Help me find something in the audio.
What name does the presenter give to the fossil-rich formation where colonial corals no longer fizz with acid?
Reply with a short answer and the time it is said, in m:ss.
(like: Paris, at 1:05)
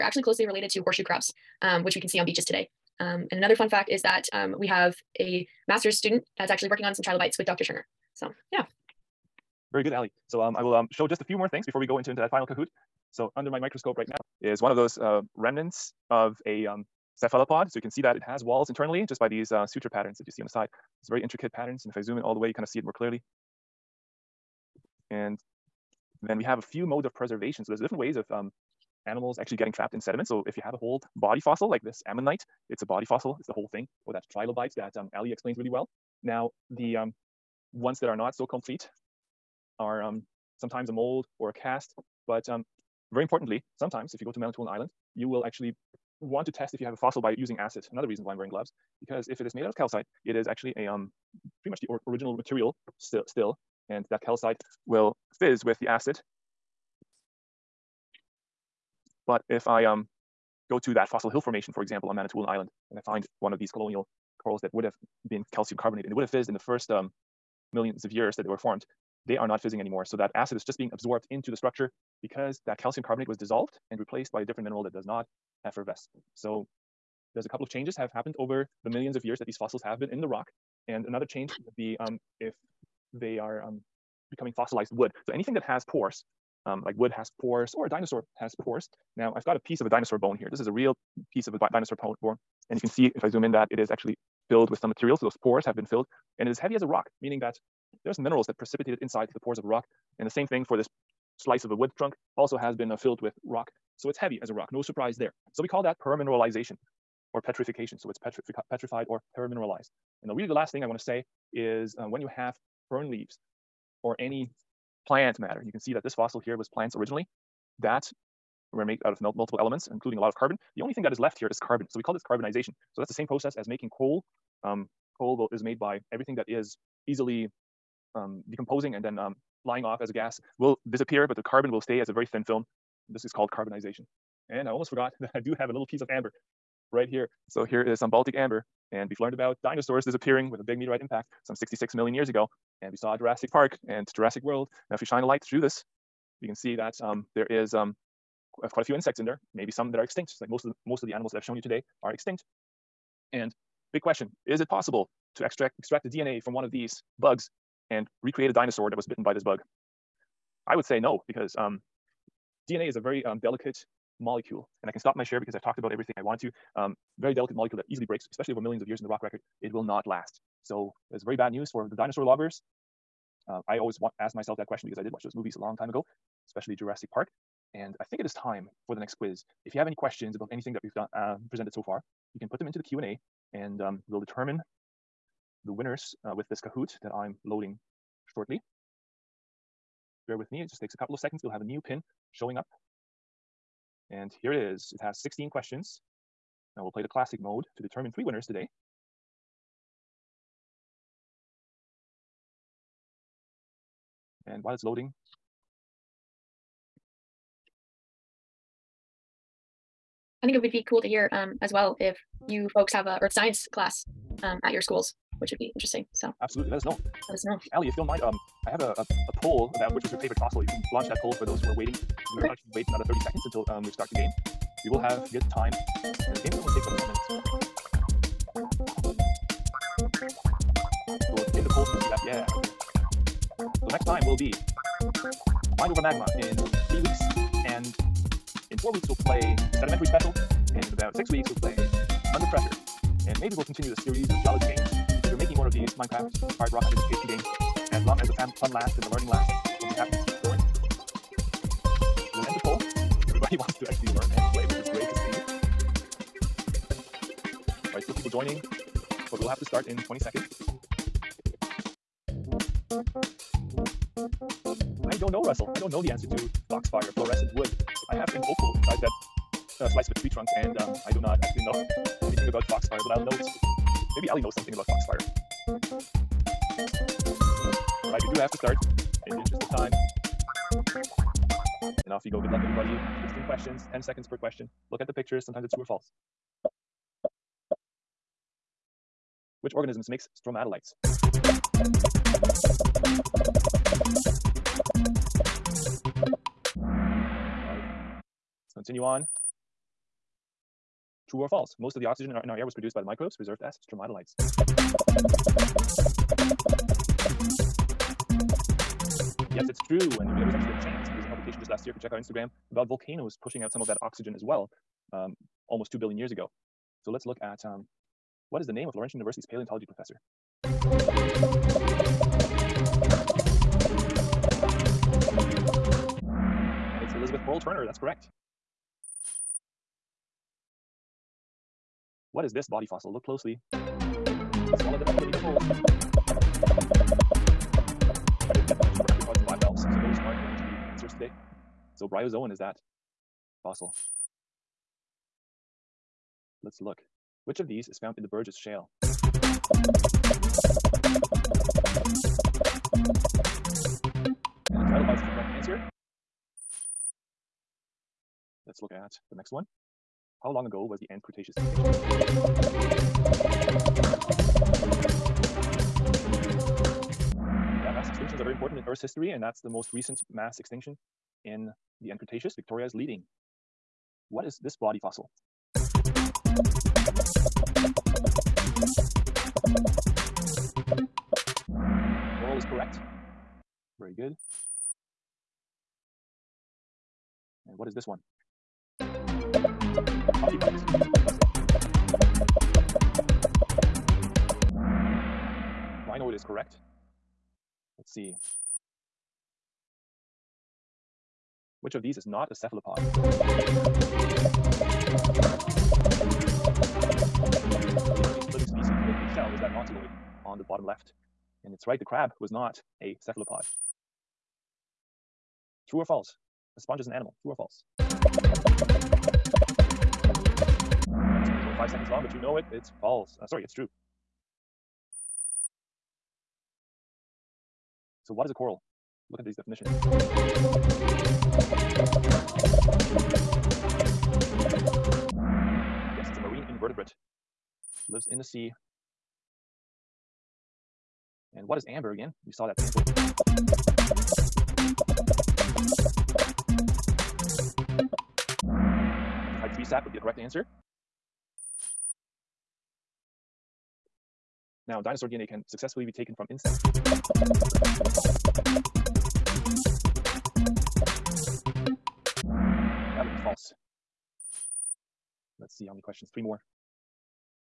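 fossil hill formation, at 1:01.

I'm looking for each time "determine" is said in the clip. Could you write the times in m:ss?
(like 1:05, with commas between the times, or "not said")
3:04, 3:17.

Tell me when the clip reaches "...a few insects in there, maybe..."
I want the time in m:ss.
2:28.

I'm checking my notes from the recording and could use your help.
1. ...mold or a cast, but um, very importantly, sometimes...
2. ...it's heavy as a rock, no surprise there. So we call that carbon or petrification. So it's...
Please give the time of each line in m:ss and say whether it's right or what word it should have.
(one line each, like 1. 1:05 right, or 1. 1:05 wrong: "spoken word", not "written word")
1. 0:40 right
2. 1:44 wrong: "permineralization", not "carbon".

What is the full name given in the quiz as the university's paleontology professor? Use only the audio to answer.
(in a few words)
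Elizabeth Pearl Turner.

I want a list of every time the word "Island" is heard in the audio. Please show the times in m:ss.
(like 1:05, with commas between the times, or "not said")
0:44, 1:02.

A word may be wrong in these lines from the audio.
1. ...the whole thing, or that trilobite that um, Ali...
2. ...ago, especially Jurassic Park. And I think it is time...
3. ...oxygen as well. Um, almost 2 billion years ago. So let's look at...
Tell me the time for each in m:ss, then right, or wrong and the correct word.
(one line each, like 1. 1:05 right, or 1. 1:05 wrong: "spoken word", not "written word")
1. 0:33 right
2. 2:55 right
3. 5:14 right.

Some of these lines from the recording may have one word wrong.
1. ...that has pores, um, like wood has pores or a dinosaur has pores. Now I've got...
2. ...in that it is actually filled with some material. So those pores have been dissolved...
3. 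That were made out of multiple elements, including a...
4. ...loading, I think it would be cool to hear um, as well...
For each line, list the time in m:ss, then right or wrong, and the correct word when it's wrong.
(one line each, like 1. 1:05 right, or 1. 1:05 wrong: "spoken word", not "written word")
1. 1:25 right
2. 1:33 wrong: "filled", not "dissolved"
3. 1:57 right
4. 3:24 right.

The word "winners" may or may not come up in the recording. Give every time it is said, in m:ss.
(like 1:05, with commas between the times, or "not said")
3:05, 3:18.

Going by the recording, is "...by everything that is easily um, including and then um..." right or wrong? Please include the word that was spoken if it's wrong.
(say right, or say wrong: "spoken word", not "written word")
wrong: "decomposing", not "including".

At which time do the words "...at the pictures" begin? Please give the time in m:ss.
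4:45.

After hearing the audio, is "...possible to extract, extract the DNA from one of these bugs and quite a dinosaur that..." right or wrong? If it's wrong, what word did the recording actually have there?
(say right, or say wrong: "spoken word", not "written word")
wrong: "recreate", not "quite".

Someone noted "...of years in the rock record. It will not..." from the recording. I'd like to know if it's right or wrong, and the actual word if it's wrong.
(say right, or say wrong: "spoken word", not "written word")
right.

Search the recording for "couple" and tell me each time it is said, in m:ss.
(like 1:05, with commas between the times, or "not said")
1:17, 3:10.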